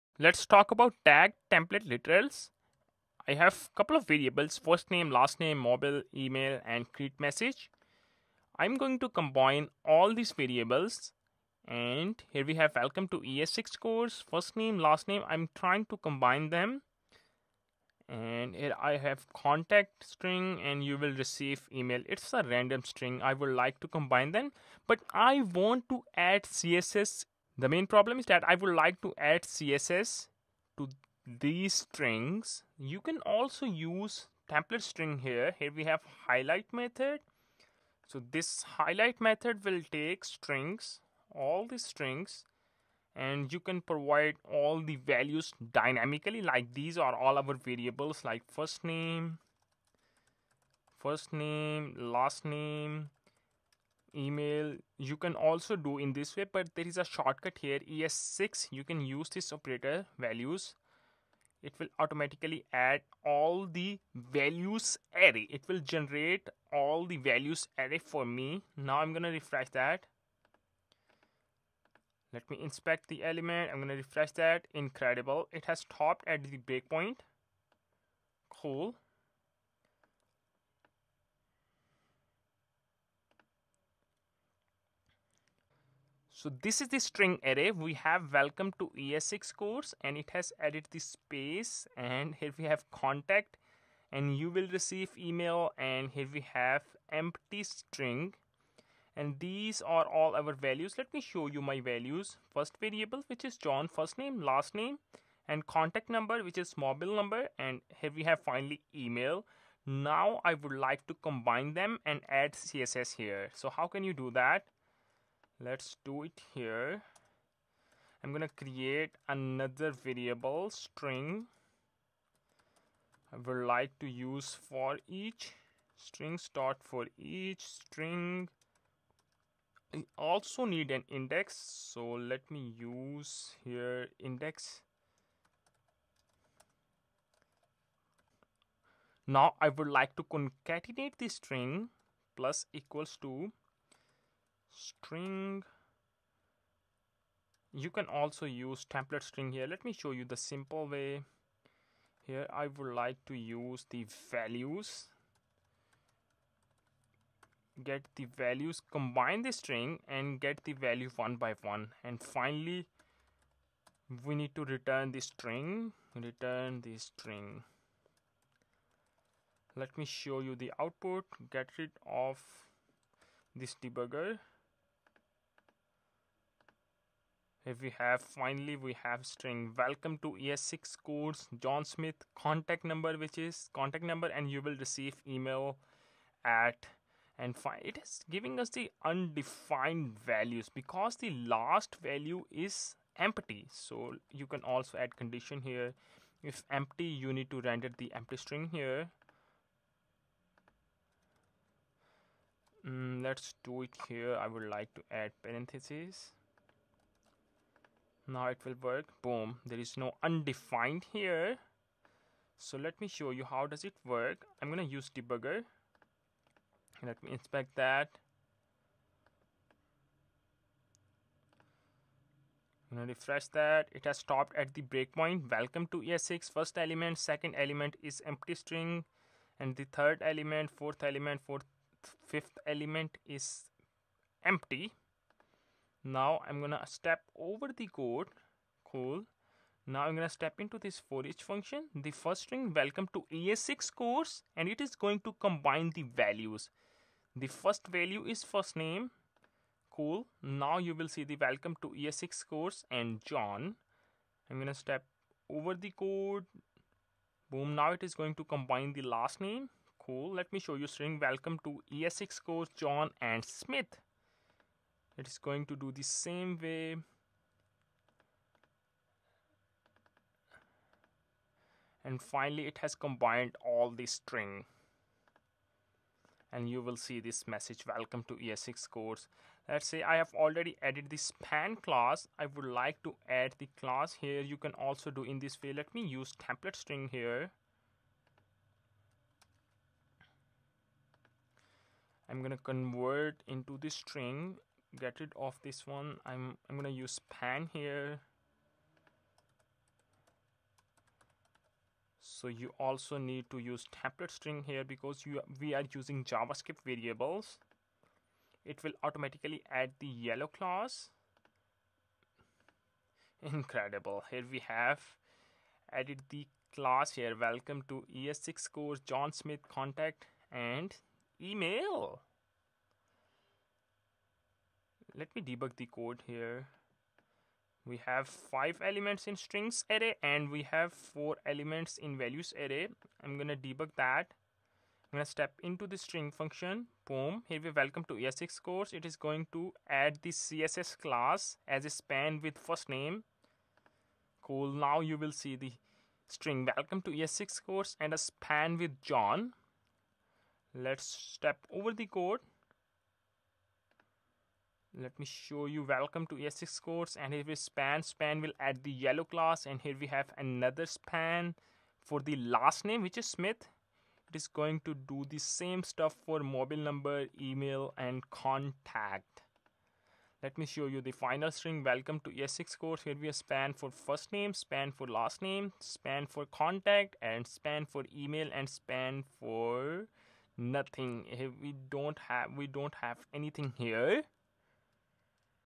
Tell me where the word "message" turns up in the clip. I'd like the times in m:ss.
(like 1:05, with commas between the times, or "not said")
0:07, 4:37.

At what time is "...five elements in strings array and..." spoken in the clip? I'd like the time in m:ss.
5:28.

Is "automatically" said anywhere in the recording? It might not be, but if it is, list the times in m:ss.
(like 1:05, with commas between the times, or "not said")
1:01, 5:09.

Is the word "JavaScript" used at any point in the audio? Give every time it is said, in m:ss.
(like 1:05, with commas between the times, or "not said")
5:06.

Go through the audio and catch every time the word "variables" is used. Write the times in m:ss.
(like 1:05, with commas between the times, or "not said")
0:04, 0:10, 0:47, 1:42, 1:59, 5:06.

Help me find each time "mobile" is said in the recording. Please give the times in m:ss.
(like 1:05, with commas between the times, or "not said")
0:05, 1:46, 6:06.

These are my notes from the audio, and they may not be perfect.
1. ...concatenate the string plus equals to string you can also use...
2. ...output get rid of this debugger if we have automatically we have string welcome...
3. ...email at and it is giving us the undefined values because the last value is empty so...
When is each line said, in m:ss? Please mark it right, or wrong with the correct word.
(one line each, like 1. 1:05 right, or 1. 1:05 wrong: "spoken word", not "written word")
1. 2:20 right
2. 2:50 wrong: "finally", not "automatically"
3. 3:05 right.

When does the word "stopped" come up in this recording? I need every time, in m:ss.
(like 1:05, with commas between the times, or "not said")
1:15, 3:44.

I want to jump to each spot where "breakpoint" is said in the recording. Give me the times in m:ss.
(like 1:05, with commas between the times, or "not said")
1:16, 3:44.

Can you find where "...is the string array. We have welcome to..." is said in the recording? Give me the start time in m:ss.
1:26.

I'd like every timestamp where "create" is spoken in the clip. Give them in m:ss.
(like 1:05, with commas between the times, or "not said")
0:06, 1:58.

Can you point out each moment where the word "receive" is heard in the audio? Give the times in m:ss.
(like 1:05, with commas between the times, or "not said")
0:21, 1:34, 3:04.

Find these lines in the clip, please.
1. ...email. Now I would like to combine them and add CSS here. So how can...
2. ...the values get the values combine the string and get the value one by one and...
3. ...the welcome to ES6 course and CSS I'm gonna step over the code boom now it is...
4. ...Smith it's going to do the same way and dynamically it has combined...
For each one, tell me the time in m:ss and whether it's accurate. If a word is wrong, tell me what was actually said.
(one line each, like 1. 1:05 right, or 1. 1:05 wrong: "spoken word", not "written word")
1. 1:48 right
2. 2:33 right
3. 4:11 wrong: "John", not "CSS"
4. 4:23 wrong: "finally", not "dynamically".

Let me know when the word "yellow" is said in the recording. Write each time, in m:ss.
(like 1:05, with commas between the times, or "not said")
5:10, 5:58.